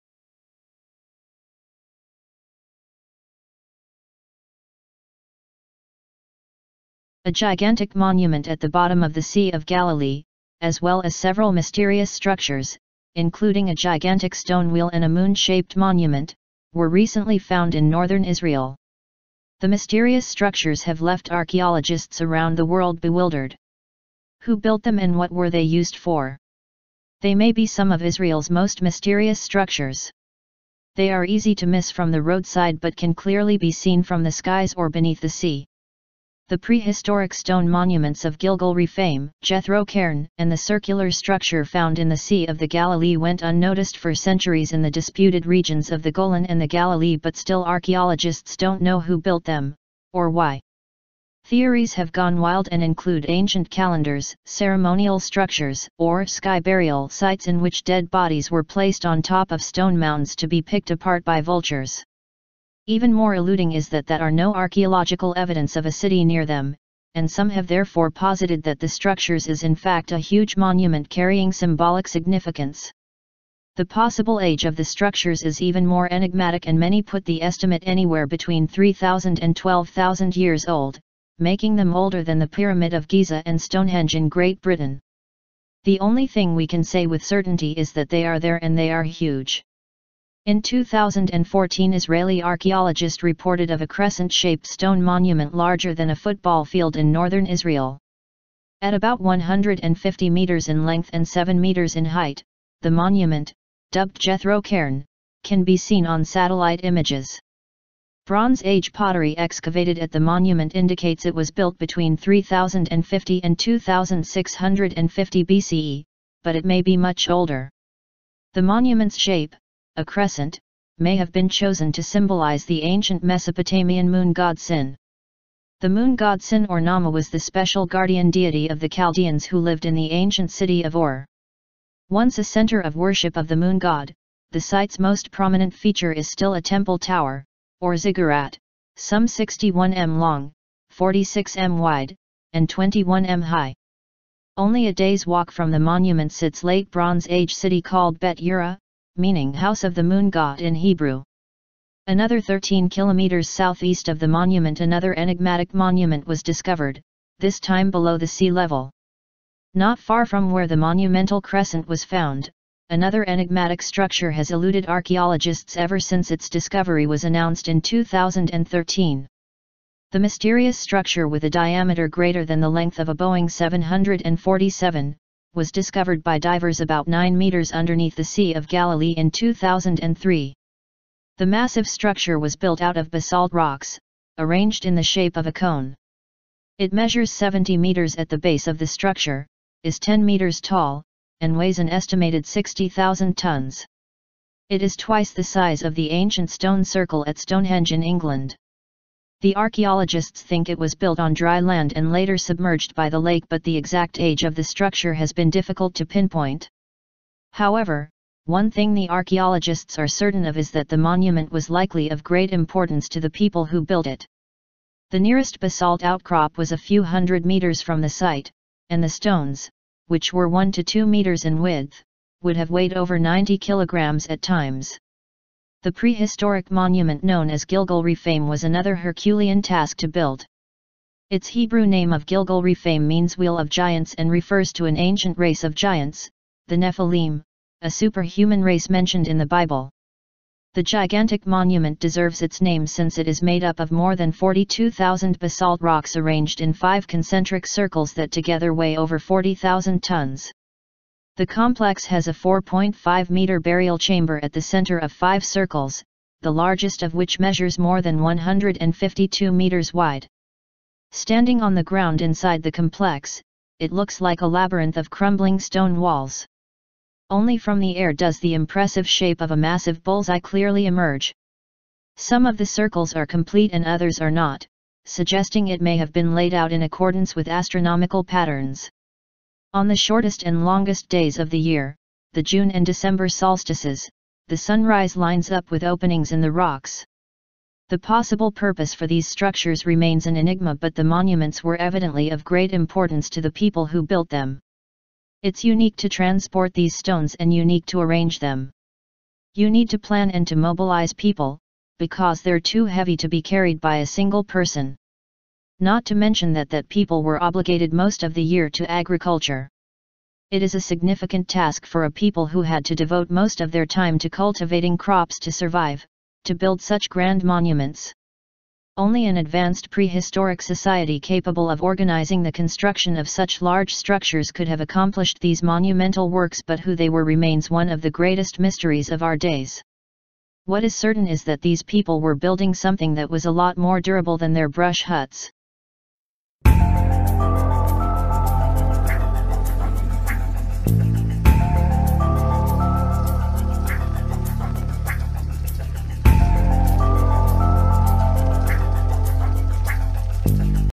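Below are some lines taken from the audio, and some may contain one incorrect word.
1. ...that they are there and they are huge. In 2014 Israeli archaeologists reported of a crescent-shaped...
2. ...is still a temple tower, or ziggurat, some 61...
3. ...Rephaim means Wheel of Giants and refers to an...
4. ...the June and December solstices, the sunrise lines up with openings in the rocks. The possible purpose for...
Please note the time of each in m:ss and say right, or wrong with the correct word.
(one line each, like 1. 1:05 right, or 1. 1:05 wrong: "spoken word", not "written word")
1. 1:27 right
2. 2:16 right
3. 3:52 right
4. 4:42 right.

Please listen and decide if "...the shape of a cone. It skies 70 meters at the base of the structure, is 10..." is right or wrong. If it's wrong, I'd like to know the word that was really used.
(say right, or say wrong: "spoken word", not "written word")
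wrong: "measures", not "skies".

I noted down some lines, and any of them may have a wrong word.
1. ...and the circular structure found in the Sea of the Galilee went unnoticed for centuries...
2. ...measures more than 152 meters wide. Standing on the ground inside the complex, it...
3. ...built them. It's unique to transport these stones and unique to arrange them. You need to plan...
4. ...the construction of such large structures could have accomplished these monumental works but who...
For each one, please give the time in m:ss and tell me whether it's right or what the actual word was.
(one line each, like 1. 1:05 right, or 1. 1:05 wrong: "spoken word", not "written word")
1. 0:40 right
2. 4:17 right
3. 4:54 right
4. 5:22 right.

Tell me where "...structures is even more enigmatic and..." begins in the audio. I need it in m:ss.
1:14.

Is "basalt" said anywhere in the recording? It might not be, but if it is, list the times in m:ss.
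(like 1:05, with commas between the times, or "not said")
3:03, 3:35, 4:05.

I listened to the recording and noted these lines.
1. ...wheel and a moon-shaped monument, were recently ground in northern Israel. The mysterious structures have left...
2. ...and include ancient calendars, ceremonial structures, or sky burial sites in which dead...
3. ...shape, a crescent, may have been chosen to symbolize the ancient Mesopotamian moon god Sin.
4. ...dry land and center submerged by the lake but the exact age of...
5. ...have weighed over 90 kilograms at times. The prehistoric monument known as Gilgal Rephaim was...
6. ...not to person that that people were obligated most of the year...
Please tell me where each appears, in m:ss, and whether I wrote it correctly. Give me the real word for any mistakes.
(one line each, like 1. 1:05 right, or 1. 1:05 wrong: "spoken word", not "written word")
1. 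0:14 wrong: "found", not "ground"
2. 0:52 right
3. 1:59 right
4. 3:21 wrong: "later", not "center"
5. 3:42 right
6. 5:05 wrong: "mention", not "person".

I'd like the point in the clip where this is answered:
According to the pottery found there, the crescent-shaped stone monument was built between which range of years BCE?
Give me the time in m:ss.
1:52.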